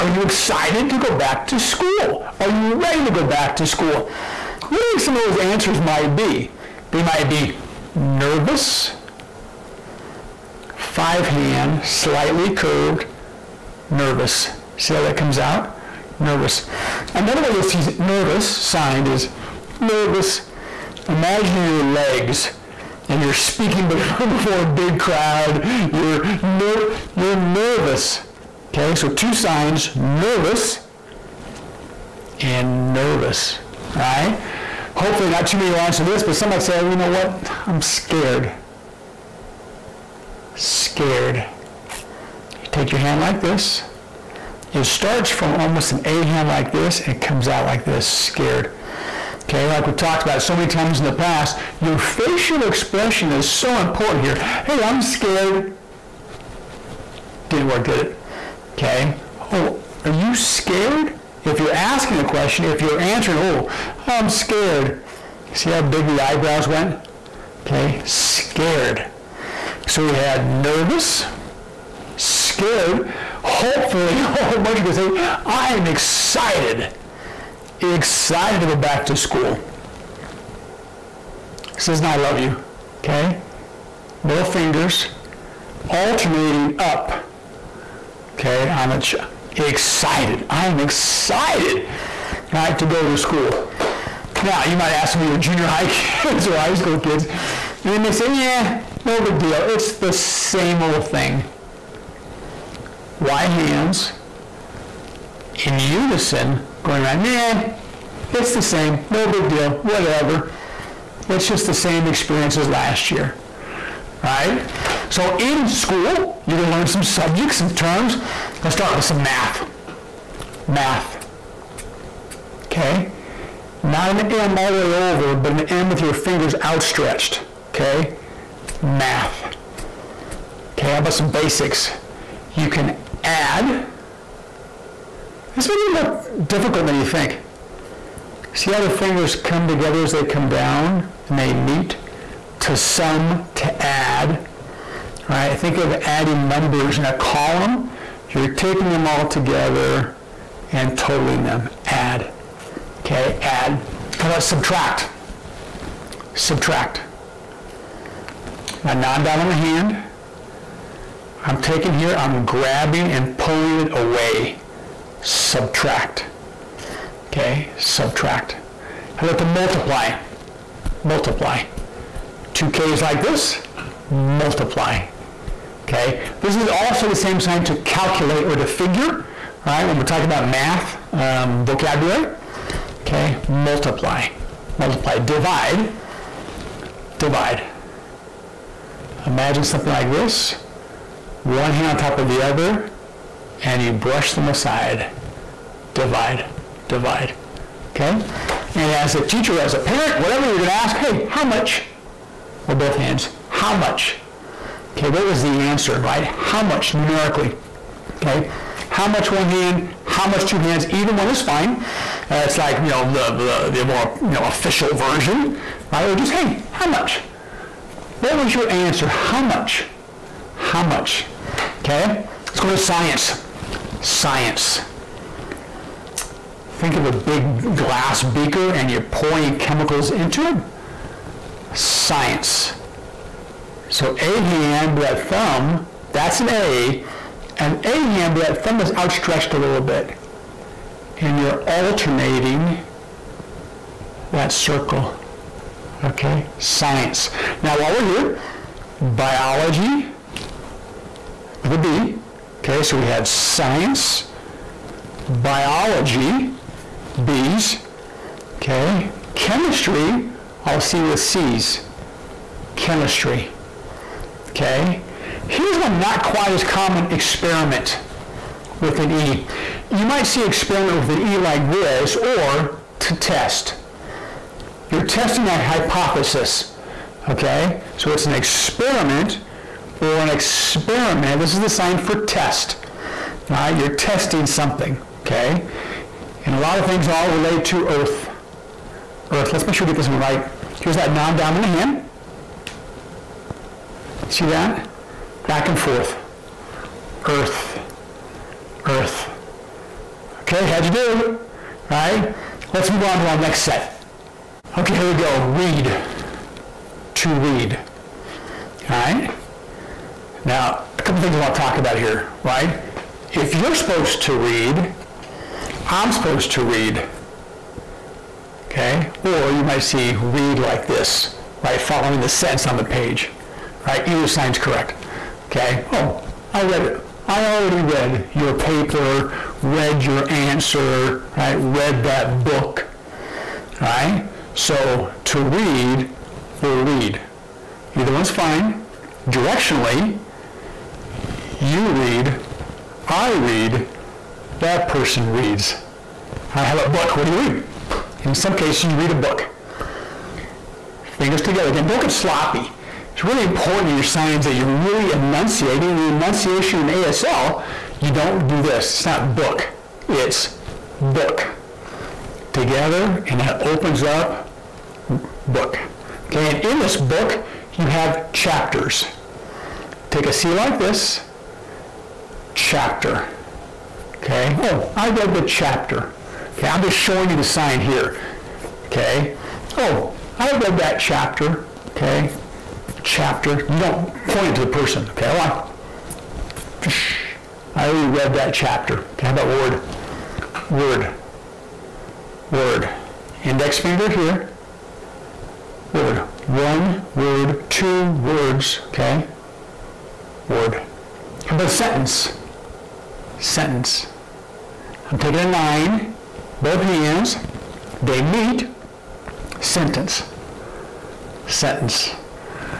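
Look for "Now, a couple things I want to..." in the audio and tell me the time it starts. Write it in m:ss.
5:10.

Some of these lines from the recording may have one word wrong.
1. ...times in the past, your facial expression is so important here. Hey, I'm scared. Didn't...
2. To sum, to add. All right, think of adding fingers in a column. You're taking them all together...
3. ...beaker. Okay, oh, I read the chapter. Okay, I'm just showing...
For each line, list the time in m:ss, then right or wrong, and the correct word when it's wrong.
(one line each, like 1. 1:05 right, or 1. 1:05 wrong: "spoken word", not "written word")
1. 0:50 right
2. 2:22 wrong: "numbers", not "fingers"
3. 6:12 wrong: "chapter", not "beaker".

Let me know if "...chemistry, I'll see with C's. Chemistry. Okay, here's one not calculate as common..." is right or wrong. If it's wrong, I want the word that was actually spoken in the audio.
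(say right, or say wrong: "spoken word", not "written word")
wrong: "quite", not "calculate".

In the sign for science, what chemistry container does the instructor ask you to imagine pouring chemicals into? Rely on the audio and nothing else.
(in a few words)
glass beaker.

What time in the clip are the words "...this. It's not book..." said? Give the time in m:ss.
5:58.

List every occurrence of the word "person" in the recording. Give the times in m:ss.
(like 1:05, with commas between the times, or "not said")
5:44, 6:24.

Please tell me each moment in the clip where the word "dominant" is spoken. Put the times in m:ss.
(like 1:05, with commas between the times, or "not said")
2:38, 4:51.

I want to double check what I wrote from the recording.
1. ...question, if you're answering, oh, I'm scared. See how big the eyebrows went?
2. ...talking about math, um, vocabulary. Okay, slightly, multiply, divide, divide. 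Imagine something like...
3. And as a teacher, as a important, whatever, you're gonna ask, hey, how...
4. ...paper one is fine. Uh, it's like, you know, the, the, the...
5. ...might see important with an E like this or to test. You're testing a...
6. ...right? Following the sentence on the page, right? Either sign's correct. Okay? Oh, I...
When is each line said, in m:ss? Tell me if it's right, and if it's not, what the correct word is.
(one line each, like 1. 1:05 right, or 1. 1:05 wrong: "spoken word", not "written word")
1. 1:02 right
2. 3:00 wrong: "multiply", not "slightly"
3. 3:18 wrong: "parent", not "important"
4. 3:30 wrong: "either", not "paper"
5. 4:30 wrong: "experiment", not "important"
6. 5:21 right.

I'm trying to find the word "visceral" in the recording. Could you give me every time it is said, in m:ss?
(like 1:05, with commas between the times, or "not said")
not said.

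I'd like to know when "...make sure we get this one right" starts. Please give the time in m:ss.
4:49.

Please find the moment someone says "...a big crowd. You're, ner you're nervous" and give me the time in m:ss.
0:24.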